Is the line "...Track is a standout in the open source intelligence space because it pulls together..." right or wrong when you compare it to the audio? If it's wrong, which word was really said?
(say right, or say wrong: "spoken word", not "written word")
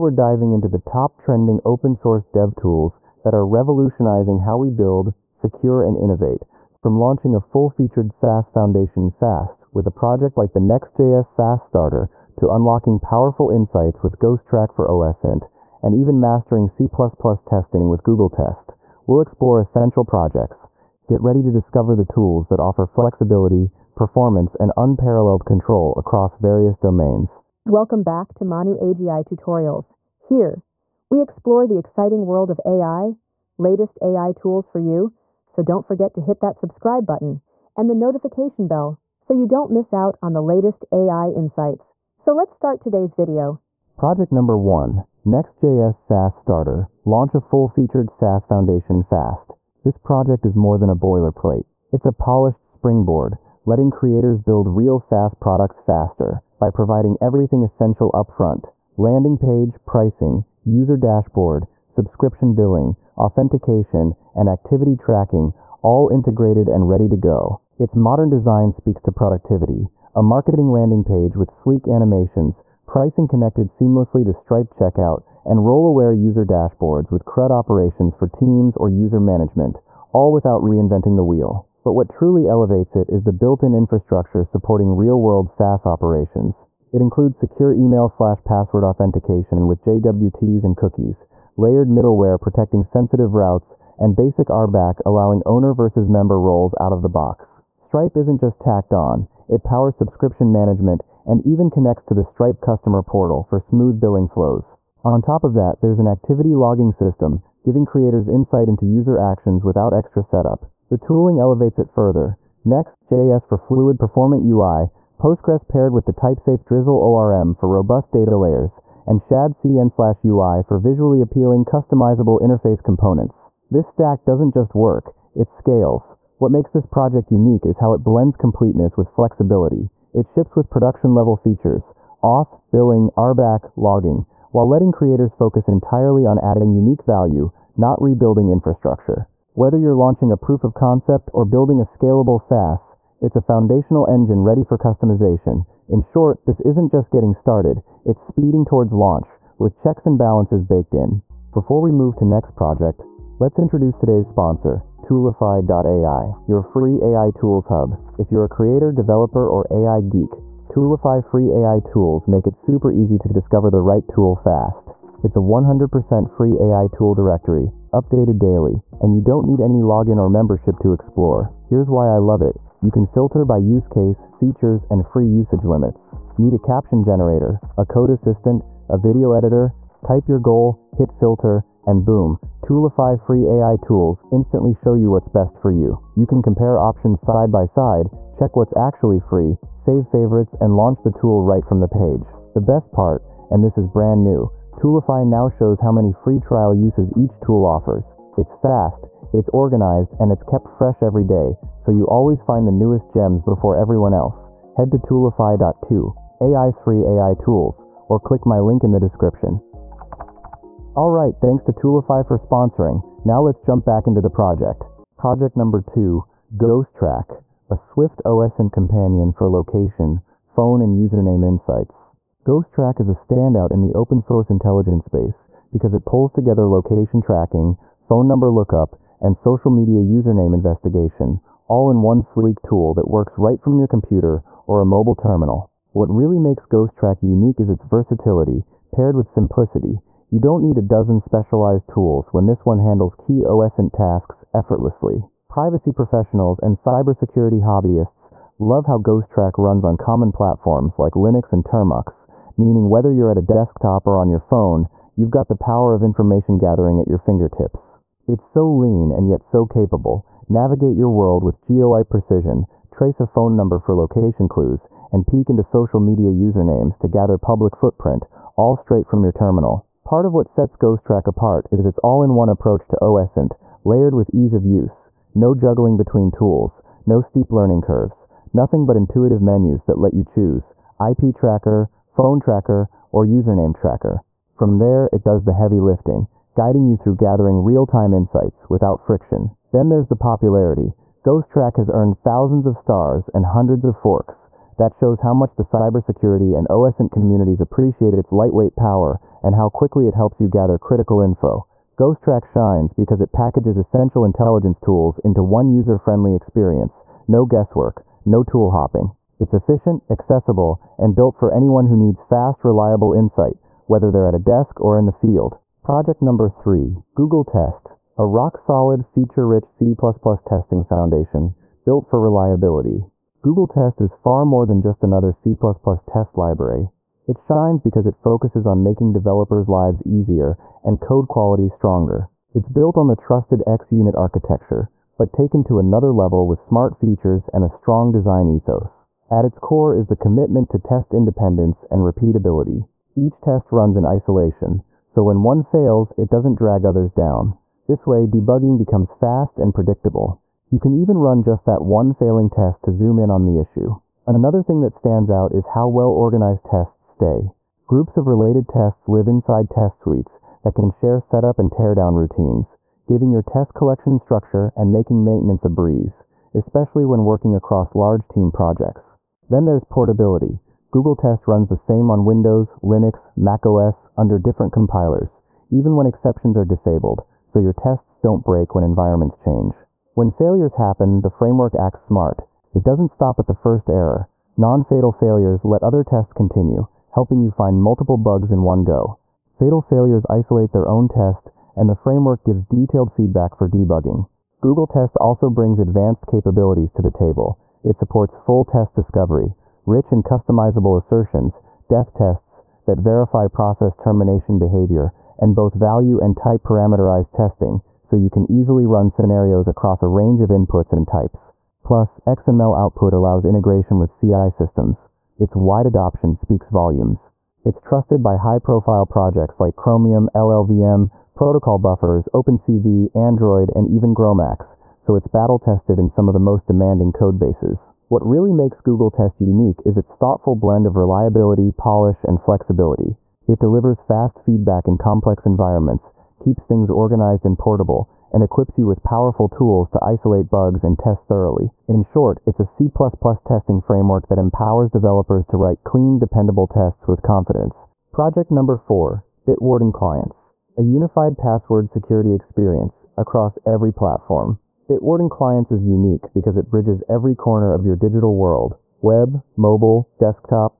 right.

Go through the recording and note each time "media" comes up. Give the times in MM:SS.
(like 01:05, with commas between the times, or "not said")
03:49, 04:26.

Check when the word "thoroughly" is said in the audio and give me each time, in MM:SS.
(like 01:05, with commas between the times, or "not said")
07:21.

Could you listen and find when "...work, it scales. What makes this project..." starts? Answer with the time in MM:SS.
02:04.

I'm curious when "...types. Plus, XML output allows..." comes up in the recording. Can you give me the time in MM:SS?
06:51.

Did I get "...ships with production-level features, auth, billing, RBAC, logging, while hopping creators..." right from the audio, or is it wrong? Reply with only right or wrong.
wrong.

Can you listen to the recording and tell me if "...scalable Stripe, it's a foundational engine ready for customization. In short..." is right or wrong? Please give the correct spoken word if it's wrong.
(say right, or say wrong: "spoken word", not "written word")
wrong: "SaaS", not "Stripe".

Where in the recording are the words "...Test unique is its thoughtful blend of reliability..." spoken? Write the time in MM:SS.
07:09.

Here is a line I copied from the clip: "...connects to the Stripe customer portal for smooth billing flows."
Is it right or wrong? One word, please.
right.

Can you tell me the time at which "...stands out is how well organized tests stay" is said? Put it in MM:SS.
05:54.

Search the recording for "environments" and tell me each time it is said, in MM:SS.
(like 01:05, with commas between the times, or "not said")
06:18, 07:15.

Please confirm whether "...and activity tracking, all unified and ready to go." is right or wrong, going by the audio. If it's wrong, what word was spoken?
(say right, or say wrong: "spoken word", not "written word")
wrong: "integrated", not "unified".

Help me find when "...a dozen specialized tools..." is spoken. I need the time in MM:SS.
04:00.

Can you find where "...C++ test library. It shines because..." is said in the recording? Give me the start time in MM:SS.
05:25.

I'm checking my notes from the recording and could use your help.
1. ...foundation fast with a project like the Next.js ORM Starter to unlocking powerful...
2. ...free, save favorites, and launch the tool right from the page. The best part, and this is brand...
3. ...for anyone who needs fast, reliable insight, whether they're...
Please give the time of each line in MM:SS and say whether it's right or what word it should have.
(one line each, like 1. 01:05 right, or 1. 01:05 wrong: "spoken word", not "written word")
1. 00:08 wrong: "SaaS", not "ORM"
2. 03:09 right
3. 05:11 right.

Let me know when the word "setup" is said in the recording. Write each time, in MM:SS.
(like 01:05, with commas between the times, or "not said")
01:50, 06:01.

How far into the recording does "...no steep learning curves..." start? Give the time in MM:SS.
04:37.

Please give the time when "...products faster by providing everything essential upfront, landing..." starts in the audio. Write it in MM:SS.
00:55.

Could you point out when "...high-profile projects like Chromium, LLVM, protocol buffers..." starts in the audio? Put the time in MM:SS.
06:58.